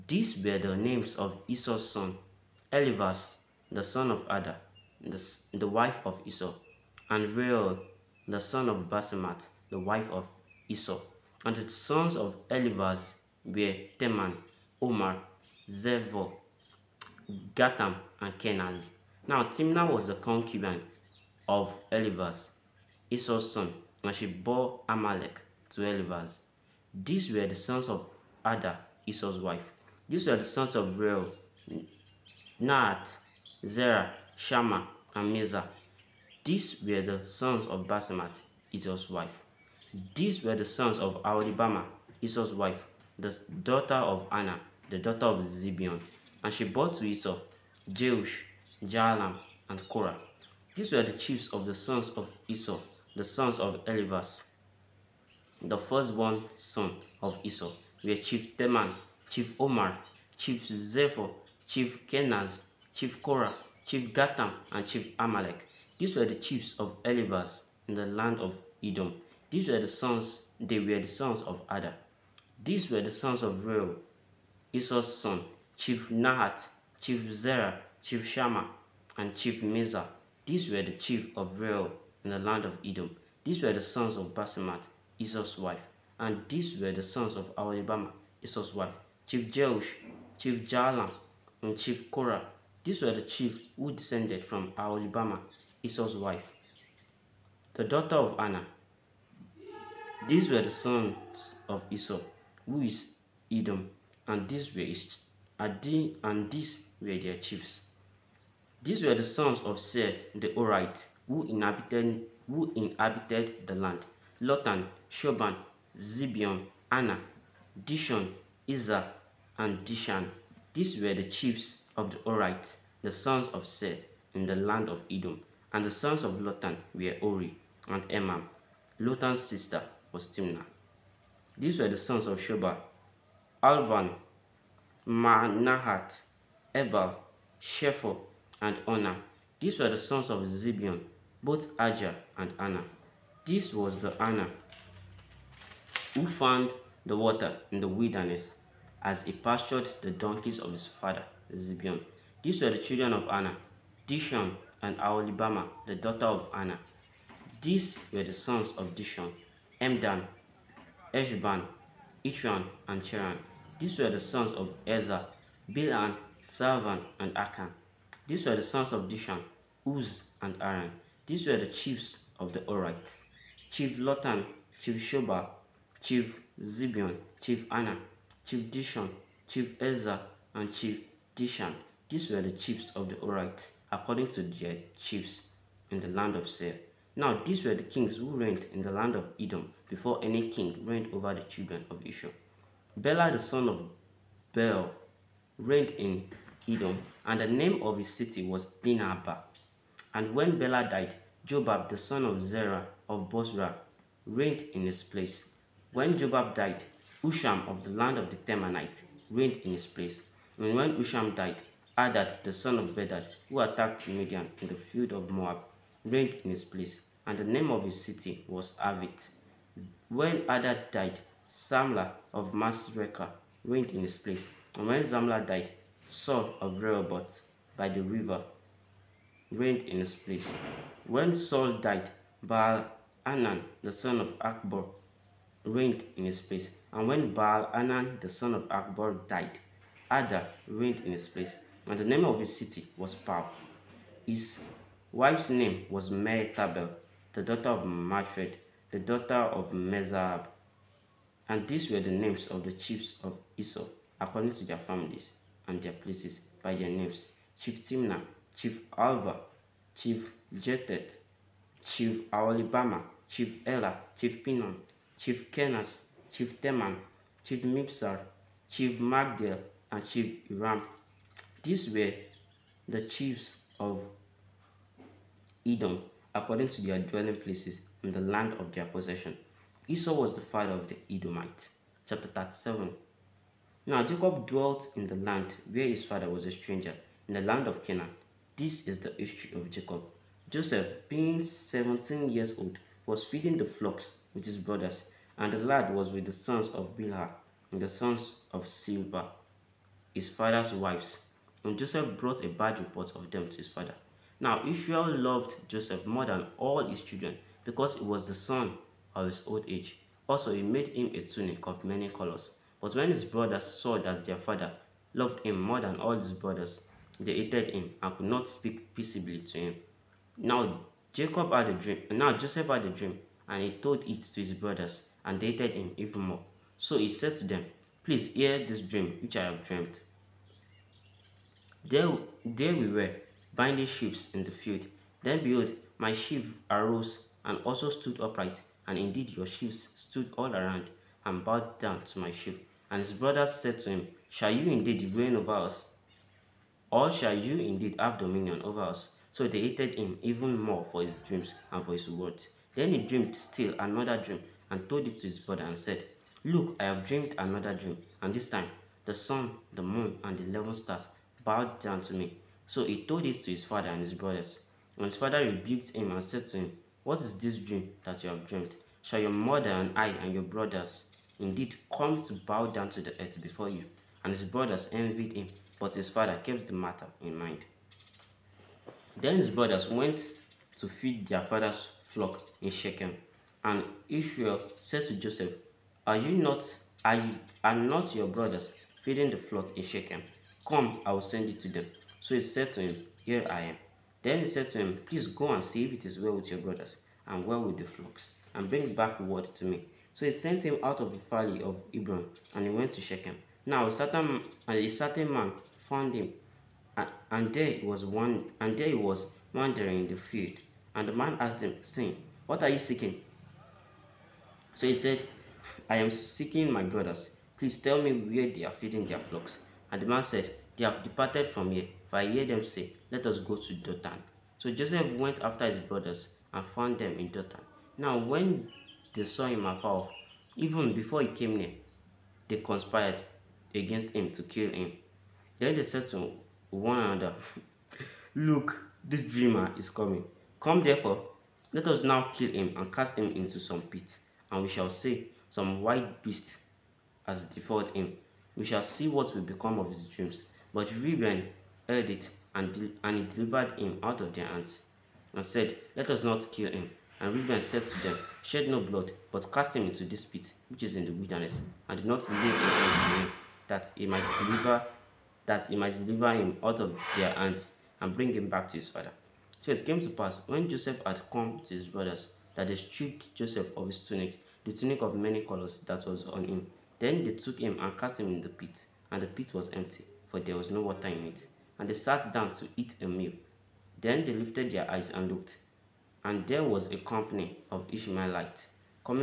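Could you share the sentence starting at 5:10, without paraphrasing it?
Also, he made him a tunic of many colors.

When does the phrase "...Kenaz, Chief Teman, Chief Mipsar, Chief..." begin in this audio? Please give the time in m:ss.
4:25.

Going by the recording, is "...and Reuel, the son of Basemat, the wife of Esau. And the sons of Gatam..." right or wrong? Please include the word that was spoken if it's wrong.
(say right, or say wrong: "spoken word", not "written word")
wrong: "Eliphaz", not "Gatam".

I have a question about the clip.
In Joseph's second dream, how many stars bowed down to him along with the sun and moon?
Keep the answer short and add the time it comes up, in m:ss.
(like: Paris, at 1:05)
11, at 6:00.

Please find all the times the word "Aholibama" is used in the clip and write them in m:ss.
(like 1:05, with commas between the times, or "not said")
1:27, 1:34.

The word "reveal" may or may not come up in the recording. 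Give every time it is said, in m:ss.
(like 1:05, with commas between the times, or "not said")
not said.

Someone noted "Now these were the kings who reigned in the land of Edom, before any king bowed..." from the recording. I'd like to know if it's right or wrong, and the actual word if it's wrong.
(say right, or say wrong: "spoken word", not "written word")
wrong: "reigned", not "bowed".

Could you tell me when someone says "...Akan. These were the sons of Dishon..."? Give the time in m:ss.
2:47.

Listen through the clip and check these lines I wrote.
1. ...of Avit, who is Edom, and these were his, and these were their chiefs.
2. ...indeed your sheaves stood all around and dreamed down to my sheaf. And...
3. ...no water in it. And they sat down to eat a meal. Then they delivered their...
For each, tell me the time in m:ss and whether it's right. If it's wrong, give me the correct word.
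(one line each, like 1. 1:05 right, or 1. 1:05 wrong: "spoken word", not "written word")
1. 1:41 wrong: "Esau", not "Avit"
2. 5:38 wrong: "bowed", not "dreamed"
3. 8:00 wrong: "lifted", not "delivered".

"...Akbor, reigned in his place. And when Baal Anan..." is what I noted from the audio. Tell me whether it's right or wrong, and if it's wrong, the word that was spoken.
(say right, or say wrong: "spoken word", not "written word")
right.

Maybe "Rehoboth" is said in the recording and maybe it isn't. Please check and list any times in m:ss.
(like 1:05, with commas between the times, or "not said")
3:46.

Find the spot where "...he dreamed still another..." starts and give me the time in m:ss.
5:52.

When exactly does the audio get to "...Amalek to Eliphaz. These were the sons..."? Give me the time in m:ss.
0:24.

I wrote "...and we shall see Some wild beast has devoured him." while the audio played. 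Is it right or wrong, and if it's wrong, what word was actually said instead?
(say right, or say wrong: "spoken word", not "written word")
right.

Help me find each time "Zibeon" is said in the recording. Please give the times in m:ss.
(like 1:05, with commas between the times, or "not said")
0:45, 1:55, 2:20, 2:31, 2:56.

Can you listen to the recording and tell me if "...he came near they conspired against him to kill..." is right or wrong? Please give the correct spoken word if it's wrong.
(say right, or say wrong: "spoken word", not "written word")
right.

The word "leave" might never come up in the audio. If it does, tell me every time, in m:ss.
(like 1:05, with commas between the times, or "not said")
7:42.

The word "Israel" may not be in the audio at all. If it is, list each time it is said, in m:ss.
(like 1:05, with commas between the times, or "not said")
3:12, 5:04, 6:24.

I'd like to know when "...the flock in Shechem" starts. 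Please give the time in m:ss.
6:29.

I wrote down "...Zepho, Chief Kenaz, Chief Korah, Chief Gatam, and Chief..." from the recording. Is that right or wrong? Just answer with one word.
right.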